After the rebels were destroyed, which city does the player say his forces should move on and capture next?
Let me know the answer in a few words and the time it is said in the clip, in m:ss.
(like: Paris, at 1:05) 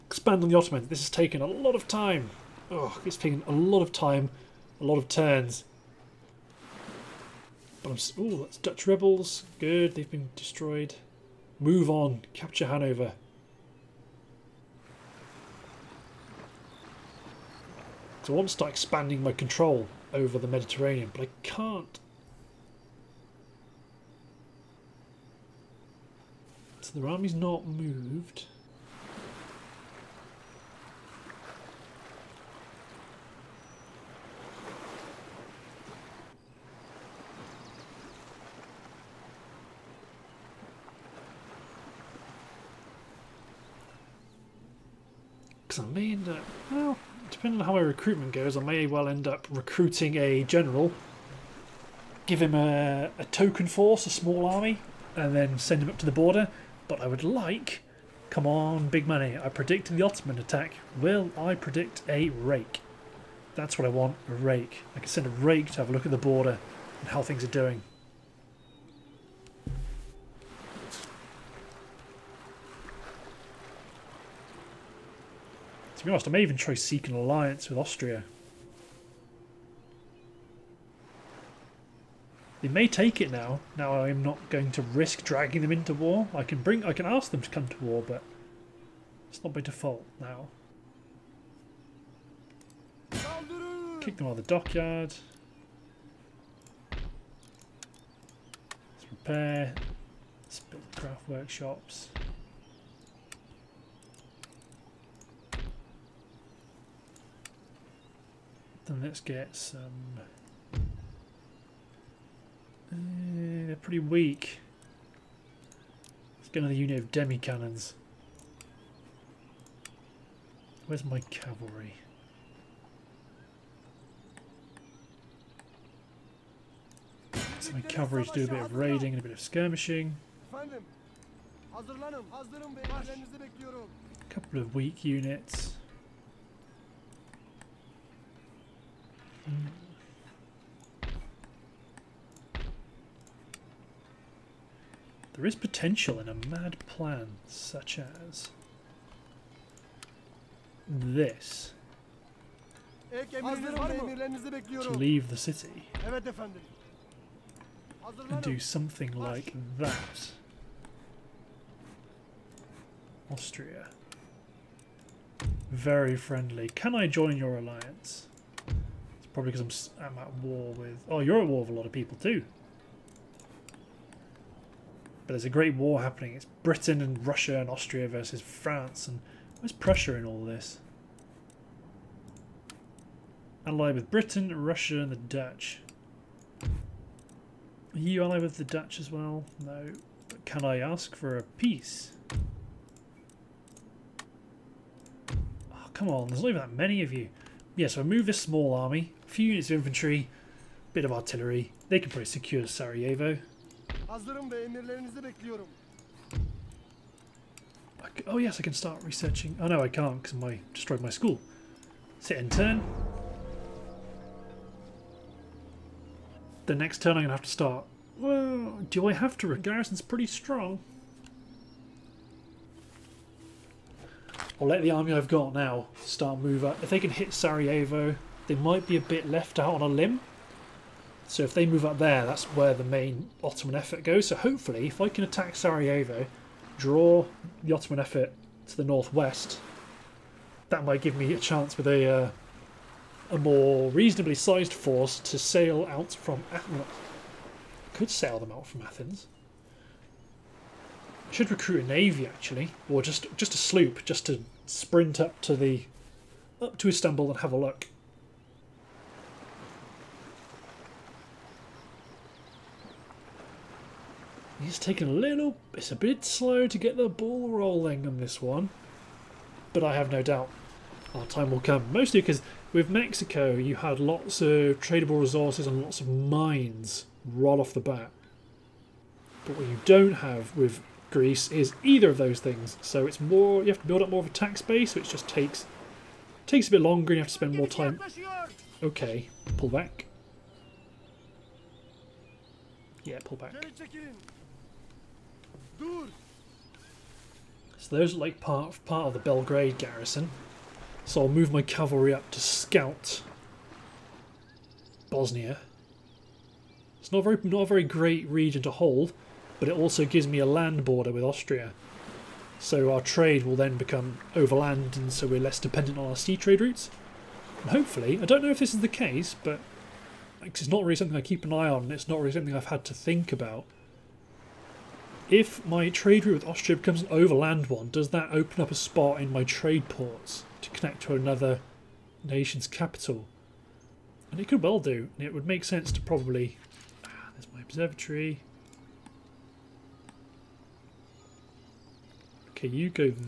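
Hanover, at 0:12.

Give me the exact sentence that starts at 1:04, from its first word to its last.
I can send a rake to have a look at the border and how things are doing.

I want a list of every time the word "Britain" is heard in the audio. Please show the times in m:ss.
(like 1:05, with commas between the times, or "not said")
2:56, 3:04.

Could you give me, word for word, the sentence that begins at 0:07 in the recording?
But I'm just, ooh, that's Dutch rebels.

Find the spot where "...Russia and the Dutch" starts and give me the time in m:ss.
3:04.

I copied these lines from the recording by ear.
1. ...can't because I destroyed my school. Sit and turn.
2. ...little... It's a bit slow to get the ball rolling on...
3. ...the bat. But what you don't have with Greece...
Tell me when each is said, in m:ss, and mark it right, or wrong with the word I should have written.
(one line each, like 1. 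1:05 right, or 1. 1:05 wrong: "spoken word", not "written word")
1. 3:29 right
2. 4:25 right
3. 4:37 right.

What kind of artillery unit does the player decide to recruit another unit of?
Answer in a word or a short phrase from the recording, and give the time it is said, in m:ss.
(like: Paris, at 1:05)
Demi-cannons, at 1:57.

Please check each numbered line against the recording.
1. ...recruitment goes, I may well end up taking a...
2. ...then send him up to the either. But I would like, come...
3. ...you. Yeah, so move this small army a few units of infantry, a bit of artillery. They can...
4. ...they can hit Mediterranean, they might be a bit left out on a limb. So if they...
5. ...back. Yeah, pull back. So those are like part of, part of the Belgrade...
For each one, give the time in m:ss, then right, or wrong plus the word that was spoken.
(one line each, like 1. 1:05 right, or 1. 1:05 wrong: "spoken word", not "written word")
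1. 0:47 wrong: "recruiting", not "taking"
2. 0:55 wrong: "border", not "either"
3. 3:17 right
4. 3:46 wrong: "Sarajevo", not "Mediterranean"
5. 4:49 right.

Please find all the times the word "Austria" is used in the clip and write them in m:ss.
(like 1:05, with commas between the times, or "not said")
1:17, 2:43, 2:57, 5:11, 5:26.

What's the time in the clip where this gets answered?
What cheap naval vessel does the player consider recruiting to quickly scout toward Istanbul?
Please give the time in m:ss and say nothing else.
4:13.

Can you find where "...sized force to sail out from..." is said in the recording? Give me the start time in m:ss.
4:04.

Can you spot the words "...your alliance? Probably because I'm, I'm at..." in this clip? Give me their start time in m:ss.
2:47.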